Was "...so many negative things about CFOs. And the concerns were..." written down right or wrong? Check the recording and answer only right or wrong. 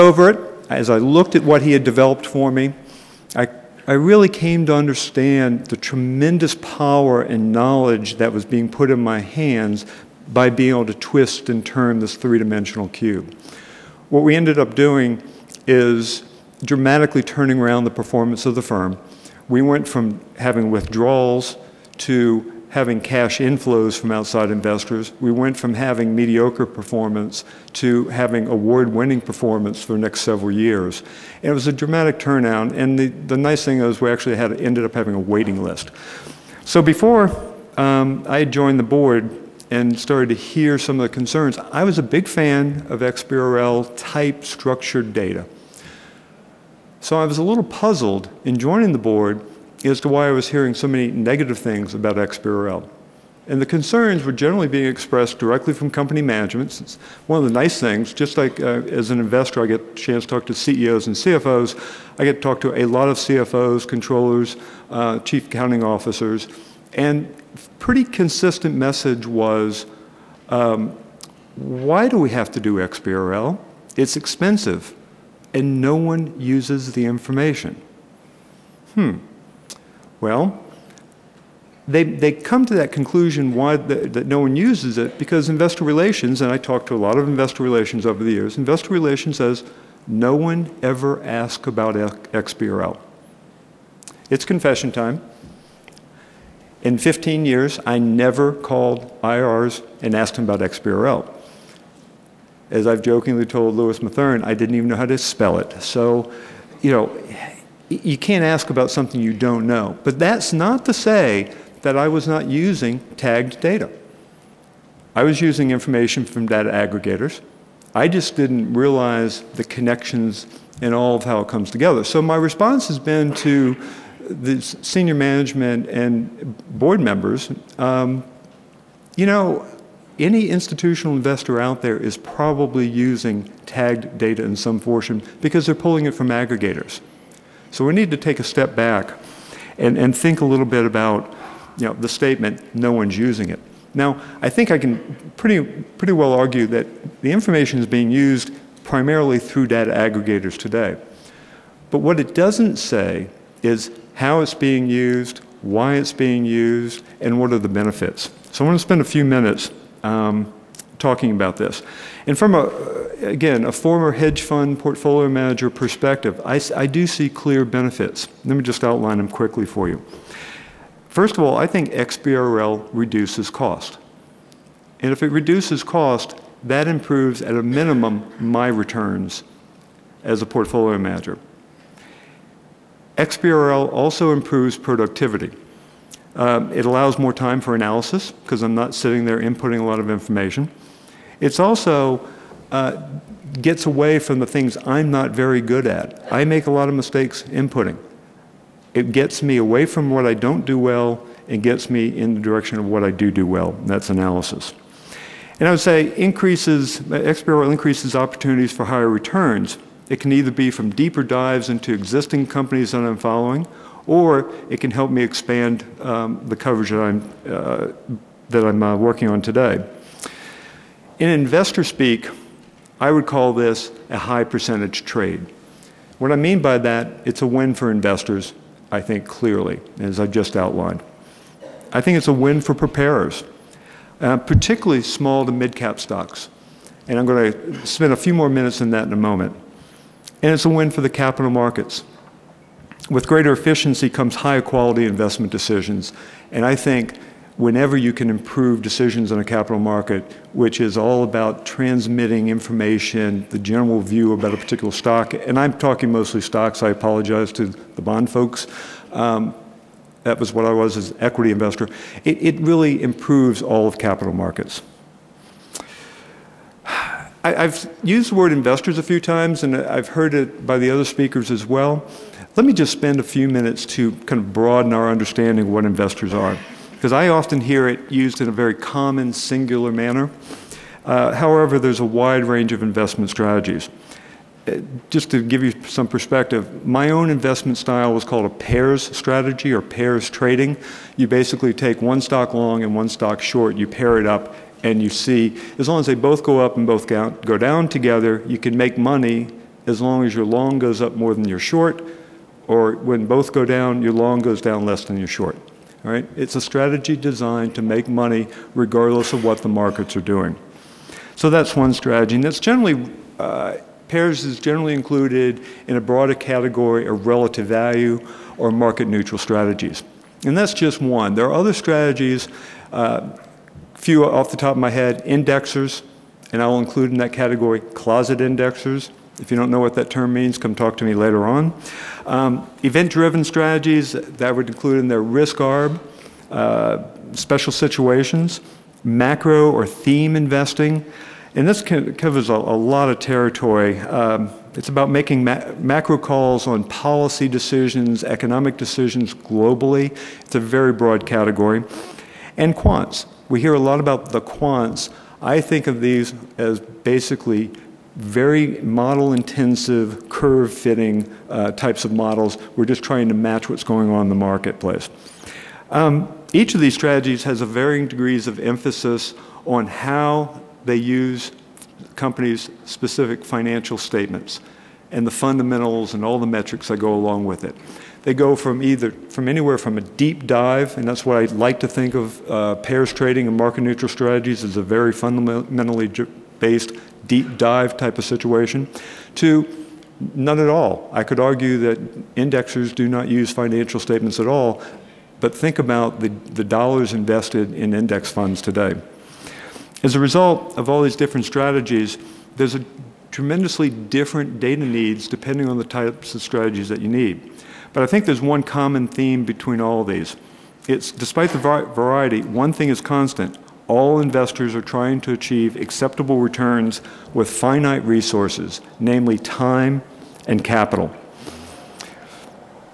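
wrong.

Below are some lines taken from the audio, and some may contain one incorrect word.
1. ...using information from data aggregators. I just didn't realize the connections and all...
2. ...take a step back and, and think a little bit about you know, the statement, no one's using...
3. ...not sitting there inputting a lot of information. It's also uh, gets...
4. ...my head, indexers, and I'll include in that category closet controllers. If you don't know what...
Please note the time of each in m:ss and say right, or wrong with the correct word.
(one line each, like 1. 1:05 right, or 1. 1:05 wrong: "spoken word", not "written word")
1. 1:55 right
2. 2:18 right
3. 3:08 right
4. 5:24 wrong: "indexers", not "controllers".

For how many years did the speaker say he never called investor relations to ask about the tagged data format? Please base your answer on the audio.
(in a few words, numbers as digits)
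15.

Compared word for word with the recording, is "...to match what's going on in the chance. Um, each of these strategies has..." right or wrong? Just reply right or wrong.
wrong.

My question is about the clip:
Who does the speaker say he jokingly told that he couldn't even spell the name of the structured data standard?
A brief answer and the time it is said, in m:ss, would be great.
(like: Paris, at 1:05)
Louis Matherne, at 1:43.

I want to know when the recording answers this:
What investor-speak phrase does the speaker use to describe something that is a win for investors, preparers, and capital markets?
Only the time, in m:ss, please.
3:44.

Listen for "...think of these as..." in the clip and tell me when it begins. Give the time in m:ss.
5:55.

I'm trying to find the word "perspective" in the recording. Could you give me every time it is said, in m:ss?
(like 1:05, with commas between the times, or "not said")
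2:45, 4:46.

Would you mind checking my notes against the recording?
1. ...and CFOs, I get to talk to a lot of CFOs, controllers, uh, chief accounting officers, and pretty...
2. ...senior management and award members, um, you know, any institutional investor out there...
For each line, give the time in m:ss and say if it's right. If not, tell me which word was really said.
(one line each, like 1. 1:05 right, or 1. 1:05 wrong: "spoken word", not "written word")
1. 1:01 right
2. 2:04 wrong: "board", not "award".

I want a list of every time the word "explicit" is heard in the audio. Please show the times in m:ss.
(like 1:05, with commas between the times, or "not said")
not said.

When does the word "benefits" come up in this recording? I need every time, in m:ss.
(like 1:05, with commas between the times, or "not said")
2:37, 2:47.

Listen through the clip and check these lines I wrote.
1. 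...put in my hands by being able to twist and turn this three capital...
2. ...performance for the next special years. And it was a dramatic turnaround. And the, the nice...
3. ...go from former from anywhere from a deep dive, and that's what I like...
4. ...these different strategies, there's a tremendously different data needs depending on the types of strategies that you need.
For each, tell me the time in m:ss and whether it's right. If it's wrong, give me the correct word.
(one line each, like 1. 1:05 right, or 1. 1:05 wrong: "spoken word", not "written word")
1. 0:08 wrong: "dimensional", not "capital"
2. 0:29 wrong: "several", not "special"
3. 6:18 wrong: "either", not "former"
4. 6:41 right.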